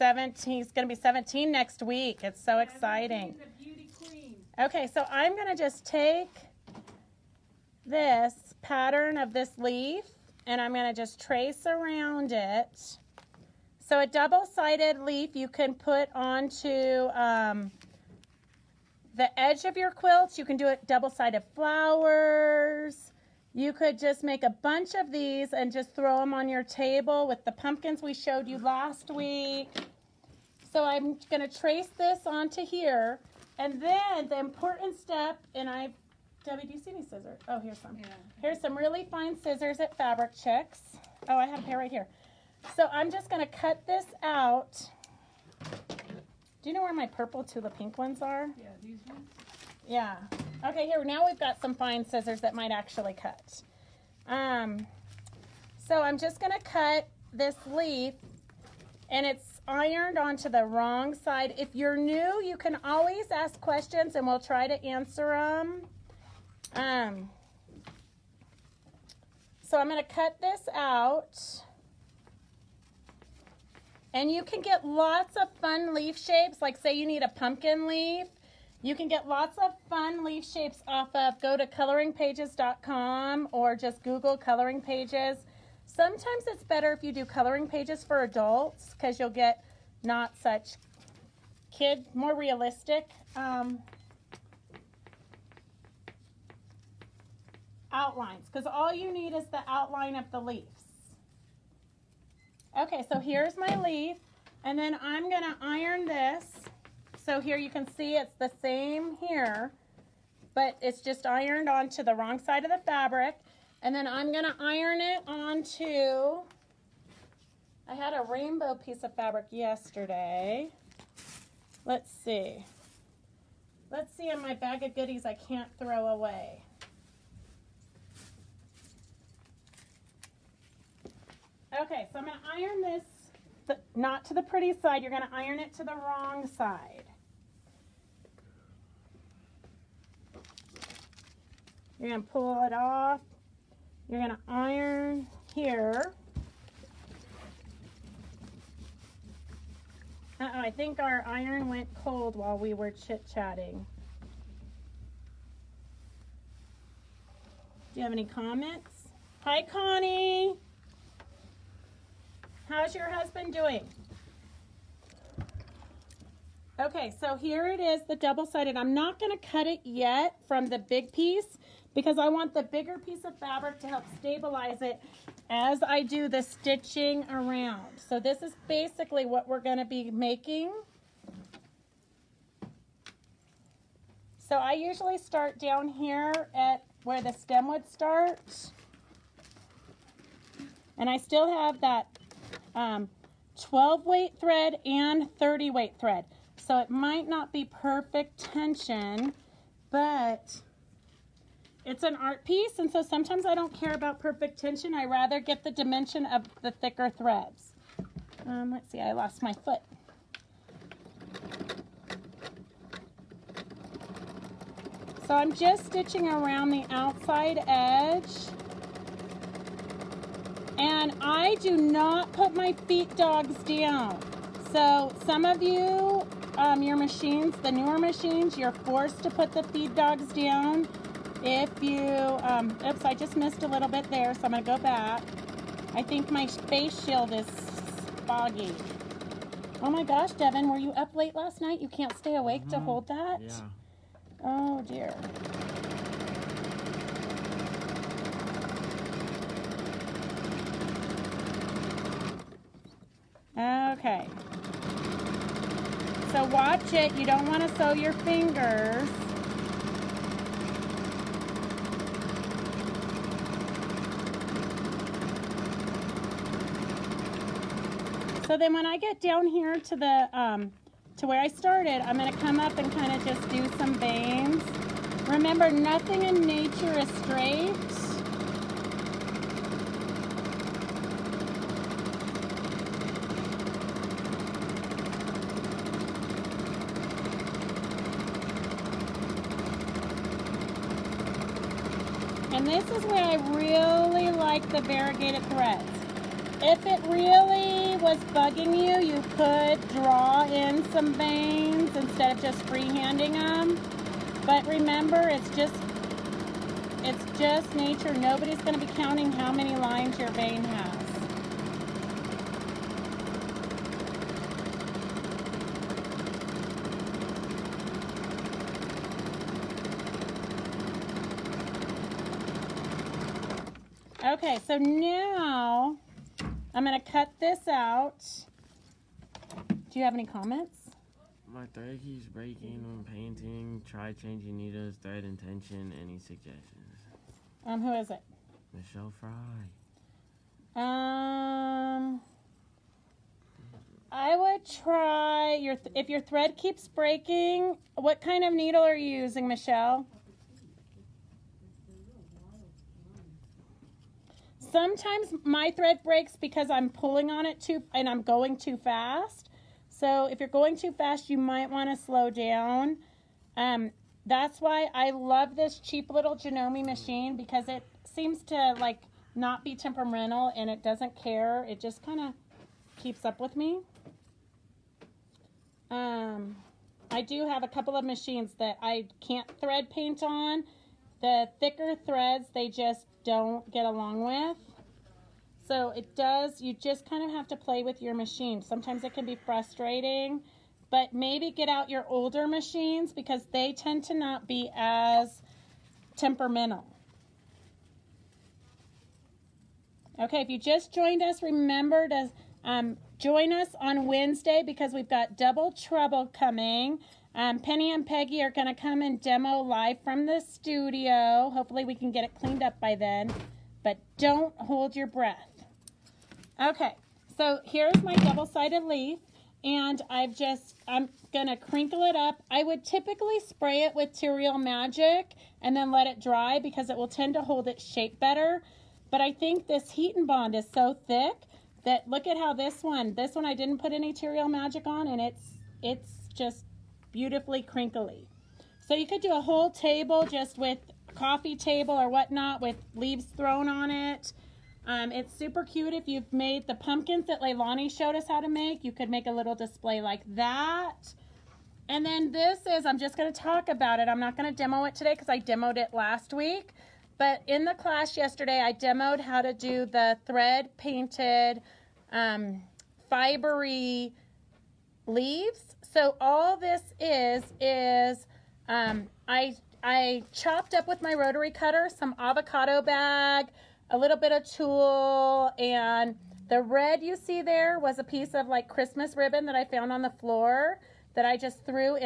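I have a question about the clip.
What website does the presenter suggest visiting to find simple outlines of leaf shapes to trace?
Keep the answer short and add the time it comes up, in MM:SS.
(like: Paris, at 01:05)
coloringpages.com, at 01:21.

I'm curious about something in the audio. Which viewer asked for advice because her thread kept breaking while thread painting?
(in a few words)
Michelle Fry.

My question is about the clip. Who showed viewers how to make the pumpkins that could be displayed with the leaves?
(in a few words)
Leilani.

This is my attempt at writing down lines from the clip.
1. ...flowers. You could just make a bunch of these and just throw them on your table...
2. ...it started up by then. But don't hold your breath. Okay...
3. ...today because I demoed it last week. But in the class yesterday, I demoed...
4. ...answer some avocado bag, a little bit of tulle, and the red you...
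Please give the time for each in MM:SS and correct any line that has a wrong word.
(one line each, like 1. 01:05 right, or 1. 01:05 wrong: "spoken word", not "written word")
1. 00:21 right
2. 06:52 wrong: "cleaned", not "started"
3. 07:34 right
4. 07:51 wrong: "cutter", not "answer".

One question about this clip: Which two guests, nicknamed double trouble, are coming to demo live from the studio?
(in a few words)
Penny and Peggy.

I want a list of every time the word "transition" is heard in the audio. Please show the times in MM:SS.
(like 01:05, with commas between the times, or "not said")
not said.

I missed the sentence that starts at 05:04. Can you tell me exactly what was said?
But remember, it's just it's just nature.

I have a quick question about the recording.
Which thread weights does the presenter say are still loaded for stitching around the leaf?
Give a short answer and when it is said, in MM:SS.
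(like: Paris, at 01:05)
12 weight and 30 weight, at 03:13.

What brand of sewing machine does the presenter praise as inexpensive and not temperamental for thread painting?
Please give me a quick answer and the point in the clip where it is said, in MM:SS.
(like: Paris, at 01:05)
Janome, at 06:06.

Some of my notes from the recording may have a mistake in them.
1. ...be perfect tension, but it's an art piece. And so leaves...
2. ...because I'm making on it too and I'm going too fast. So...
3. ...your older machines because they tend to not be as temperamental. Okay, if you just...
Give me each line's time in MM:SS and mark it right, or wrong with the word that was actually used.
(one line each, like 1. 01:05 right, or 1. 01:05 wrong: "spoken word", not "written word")
1. 03:17 wrong: "sometimes", not "leaves"
2. 05:56 wrong: "pulling", not "making"
3. 06:31 right.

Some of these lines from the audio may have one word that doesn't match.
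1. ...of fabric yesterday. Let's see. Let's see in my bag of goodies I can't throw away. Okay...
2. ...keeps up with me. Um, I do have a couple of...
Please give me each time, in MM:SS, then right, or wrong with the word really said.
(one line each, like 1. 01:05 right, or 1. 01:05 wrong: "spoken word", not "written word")
1. 01:59 right
2. 06:13 right.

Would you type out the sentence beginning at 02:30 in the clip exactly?
Uh -oh, I think our iron went cold while we were chit-chatting.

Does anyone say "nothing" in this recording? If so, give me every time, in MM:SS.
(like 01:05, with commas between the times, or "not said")
04:35.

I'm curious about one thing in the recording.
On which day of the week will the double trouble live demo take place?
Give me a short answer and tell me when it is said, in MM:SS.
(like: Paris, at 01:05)
Wednesday, at 06:44.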